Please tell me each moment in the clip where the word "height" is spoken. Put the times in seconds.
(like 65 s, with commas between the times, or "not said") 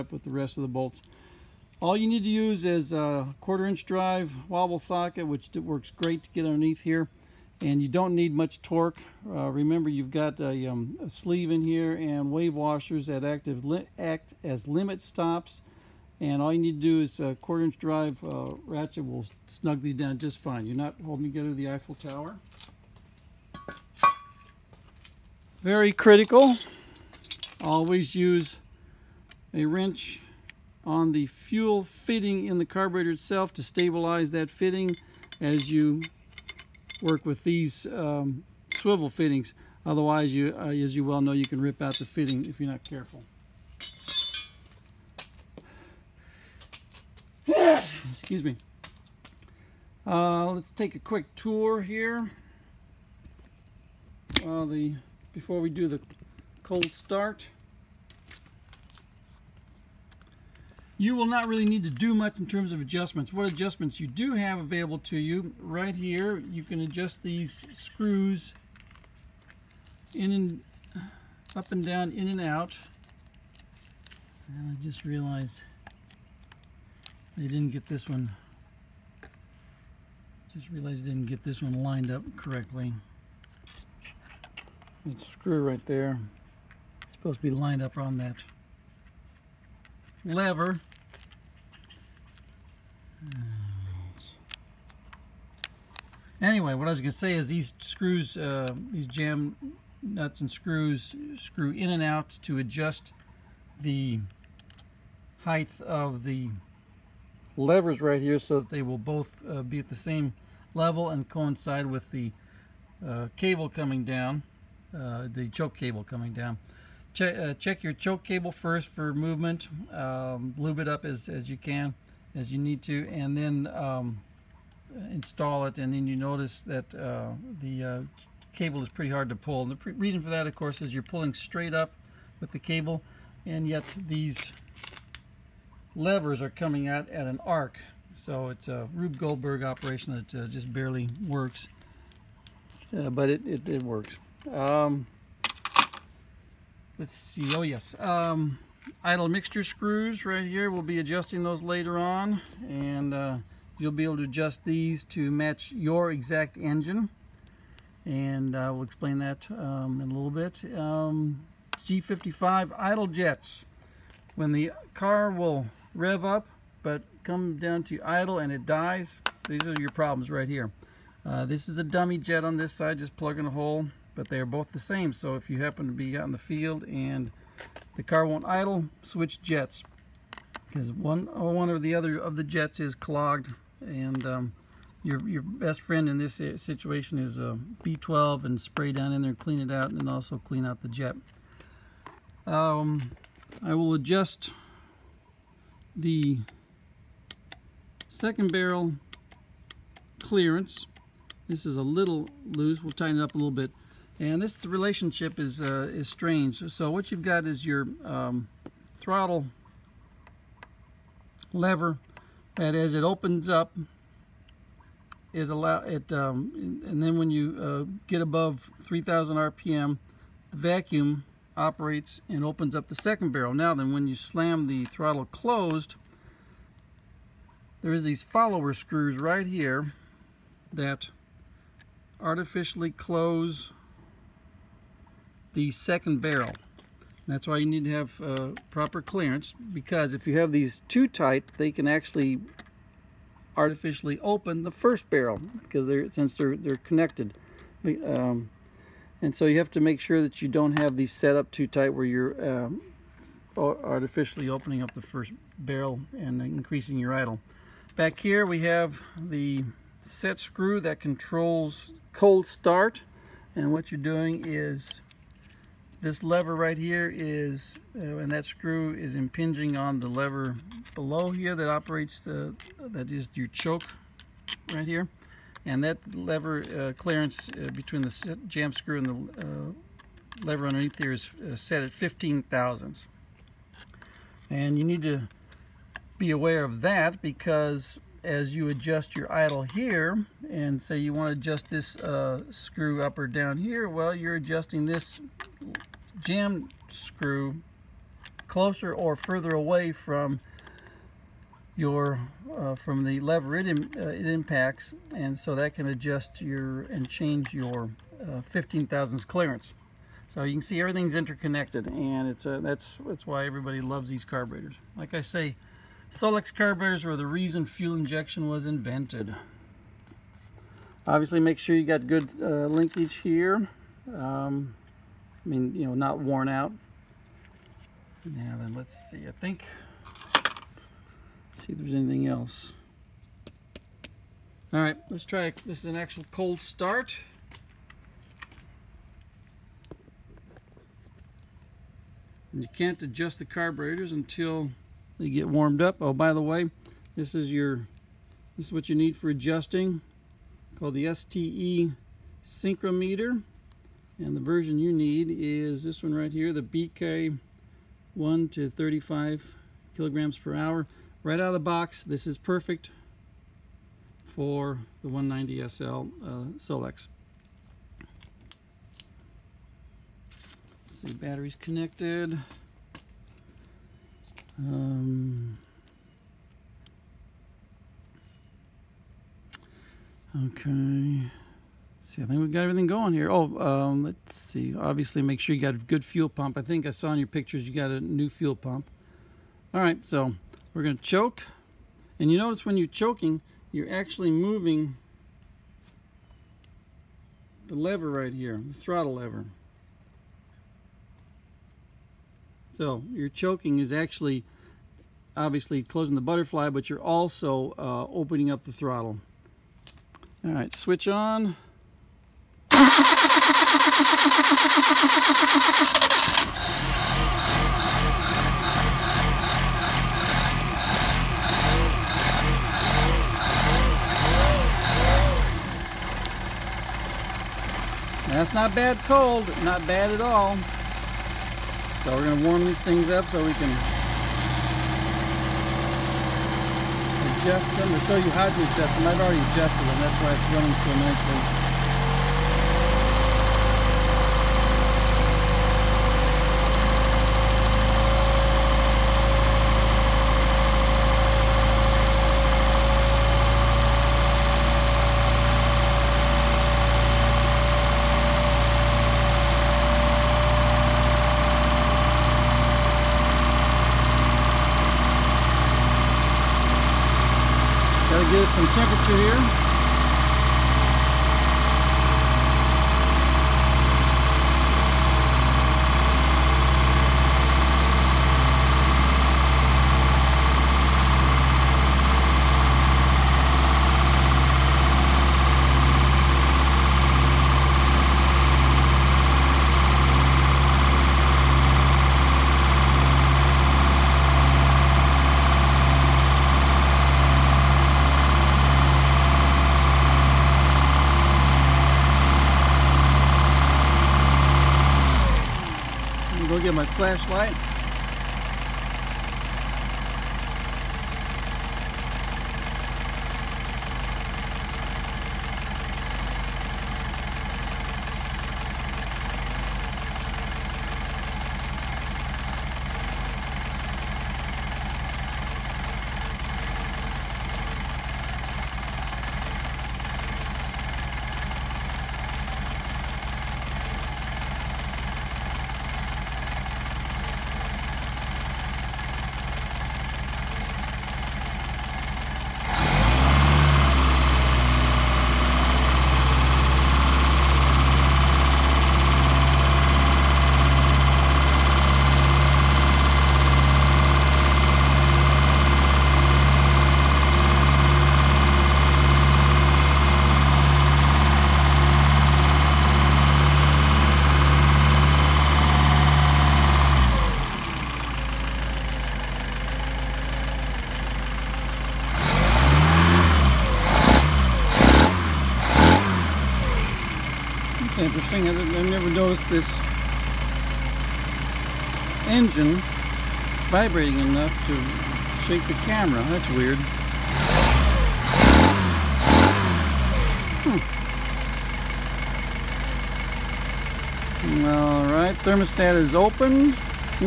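105 s.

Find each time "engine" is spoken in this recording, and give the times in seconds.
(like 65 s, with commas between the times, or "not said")
156 s, 582 s.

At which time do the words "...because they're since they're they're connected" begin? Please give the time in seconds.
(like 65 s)
245 s.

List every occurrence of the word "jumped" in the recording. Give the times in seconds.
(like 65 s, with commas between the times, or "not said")
not said.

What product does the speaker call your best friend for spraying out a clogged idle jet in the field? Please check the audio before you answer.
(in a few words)
B12.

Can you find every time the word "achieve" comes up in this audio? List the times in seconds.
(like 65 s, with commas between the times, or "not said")
not said.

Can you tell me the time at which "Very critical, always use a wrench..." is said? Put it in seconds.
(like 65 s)
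25 s.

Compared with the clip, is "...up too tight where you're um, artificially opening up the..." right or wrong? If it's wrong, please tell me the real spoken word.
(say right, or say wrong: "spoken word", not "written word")
right.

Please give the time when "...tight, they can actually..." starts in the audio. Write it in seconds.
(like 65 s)
241 s.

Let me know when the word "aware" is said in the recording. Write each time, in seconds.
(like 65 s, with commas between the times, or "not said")
286 s.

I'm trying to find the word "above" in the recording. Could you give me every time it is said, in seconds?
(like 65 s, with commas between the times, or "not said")
218 s.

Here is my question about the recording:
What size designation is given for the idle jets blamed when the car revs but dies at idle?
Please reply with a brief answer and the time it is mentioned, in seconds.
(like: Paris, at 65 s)
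G55, at 161 s.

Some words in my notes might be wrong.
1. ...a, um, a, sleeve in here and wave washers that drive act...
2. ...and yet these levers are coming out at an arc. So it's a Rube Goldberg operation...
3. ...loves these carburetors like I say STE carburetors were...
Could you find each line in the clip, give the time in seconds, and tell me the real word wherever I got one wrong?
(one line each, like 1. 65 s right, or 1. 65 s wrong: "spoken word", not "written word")
1. 10 s wrong: "active", not "drive"
2. 133 s right
3. 313 s wrong: "Solex", not "STE".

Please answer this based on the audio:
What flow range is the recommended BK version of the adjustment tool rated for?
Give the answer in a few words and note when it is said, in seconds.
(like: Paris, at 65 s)
1 to 35 kilograms per hour, at 358 s.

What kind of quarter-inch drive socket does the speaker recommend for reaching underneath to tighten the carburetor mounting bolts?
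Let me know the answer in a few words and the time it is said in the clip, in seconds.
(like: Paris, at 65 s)
wobble socket, at 4 s.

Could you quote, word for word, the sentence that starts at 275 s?
And that lever uh, clearance uh, between the jam screw and the uh, lever underneath here is uh, set at 15 thousandths.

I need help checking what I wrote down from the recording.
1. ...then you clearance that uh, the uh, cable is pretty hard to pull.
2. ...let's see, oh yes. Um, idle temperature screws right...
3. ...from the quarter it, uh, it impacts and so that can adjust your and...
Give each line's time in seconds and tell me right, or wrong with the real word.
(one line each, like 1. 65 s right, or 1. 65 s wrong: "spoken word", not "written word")
1. 125 s wrong: "notice", not "clearance"
2. 146 s wrong: "mixture", not "temperature"
3. 302 s wrong: "lever", not "quarter".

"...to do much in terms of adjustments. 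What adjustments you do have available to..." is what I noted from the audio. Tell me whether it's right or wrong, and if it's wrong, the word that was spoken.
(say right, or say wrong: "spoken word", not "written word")
right.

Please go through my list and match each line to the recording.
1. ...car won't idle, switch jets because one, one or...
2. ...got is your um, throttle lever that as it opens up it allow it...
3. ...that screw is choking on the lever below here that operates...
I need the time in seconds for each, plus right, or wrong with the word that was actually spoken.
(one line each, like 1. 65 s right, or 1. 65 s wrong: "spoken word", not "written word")
1. 178 s right
2. 207 s right
3. 268 s wrong: "impinging", not "choking".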